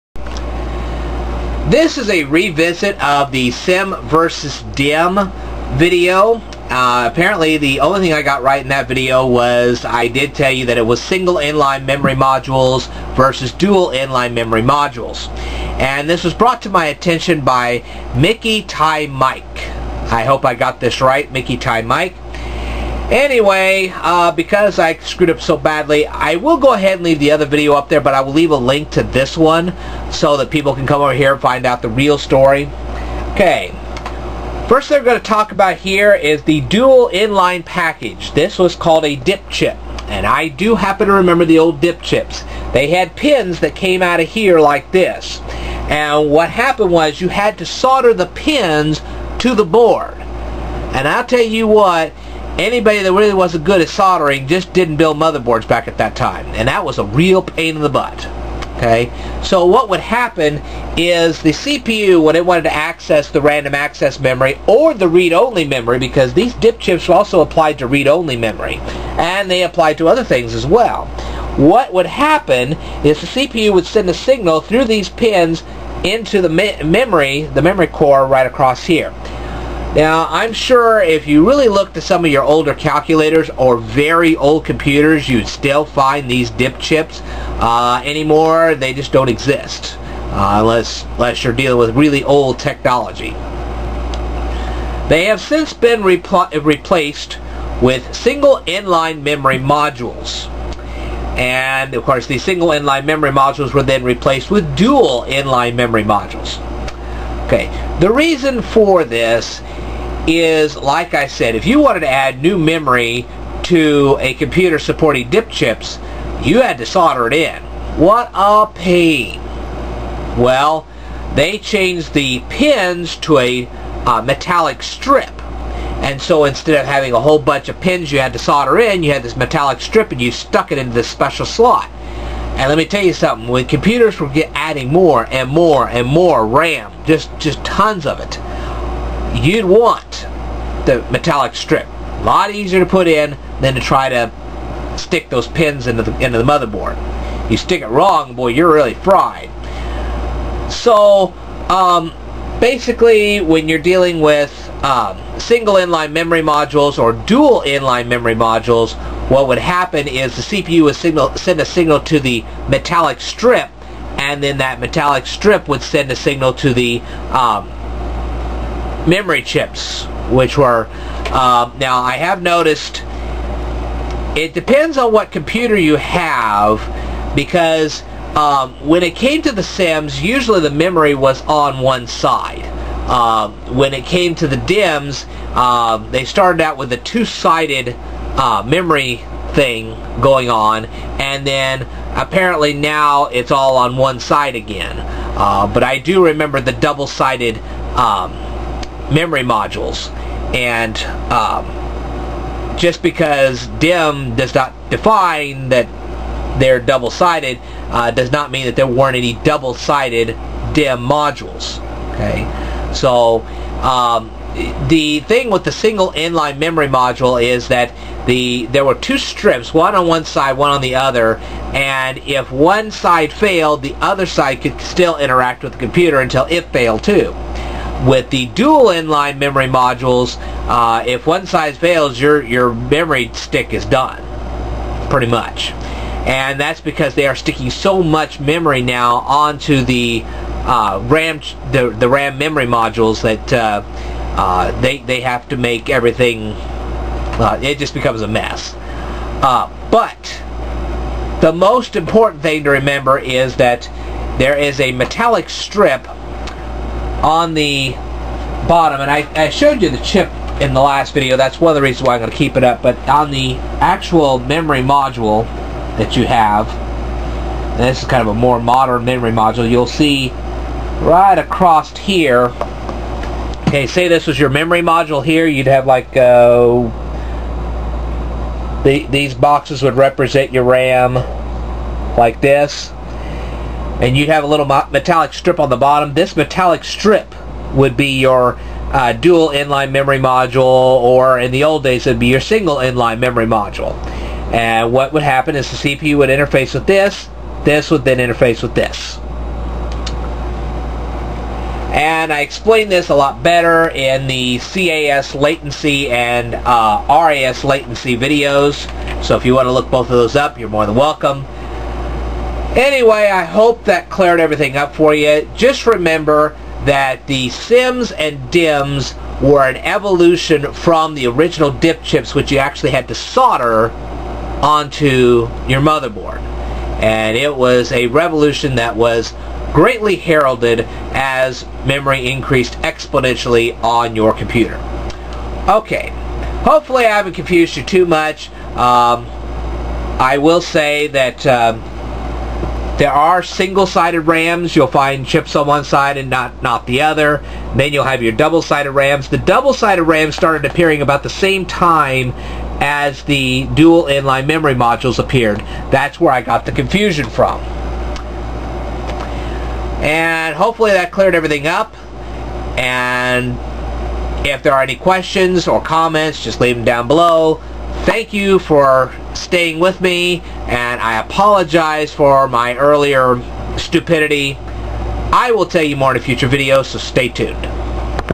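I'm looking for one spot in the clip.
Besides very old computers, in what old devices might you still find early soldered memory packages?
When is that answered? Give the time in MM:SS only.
01:22.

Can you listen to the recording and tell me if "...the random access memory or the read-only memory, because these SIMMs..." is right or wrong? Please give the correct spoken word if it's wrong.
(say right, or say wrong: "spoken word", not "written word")
wrong: "DIP", not "SIMMs".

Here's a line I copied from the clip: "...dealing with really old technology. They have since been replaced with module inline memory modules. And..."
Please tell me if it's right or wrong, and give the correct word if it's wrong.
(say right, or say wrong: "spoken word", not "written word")
wrong: "single", not "module".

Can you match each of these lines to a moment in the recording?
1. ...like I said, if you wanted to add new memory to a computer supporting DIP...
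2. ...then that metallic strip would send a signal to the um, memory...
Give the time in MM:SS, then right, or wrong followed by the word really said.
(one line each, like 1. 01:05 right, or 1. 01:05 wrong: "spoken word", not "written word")
1. 01:50 right
2. 02:44 right.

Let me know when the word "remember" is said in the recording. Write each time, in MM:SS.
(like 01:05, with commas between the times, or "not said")
00:41, 03:16, 04:12, 05:15.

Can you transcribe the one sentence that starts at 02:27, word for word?
You stick it wrong, boy, you're really fried.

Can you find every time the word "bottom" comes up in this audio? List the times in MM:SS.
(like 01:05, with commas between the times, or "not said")
04:18, 04:45.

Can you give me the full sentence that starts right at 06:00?
And hopefully that cleared everything up.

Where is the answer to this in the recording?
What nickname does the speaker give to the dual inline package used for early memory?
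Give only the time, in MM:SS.
00:39.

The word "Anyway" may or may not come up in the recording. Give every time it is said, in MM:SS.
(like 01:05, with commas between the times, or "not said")
00:23, 05:12.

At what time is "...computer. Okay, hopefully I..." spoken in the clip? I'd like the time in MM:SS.
05:34.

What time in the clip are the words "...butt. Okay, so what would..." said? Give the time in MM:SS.
00:57.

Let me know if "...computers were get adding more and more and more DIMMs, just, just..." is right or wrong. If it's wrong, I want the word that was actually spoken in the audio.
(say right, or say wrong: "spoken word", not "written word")
wrong: "RAM", not "DIMMs".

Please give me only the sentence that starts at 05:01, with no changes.
And I explained this a lot better in the CAS latency and uh, RAS latency videos.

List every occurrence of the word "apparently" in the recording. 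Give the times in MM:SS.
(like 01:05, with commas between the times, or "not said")
00:07, 03:12.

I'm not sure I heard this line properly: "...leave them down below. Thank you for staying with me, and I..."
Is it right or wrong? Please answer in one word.
right.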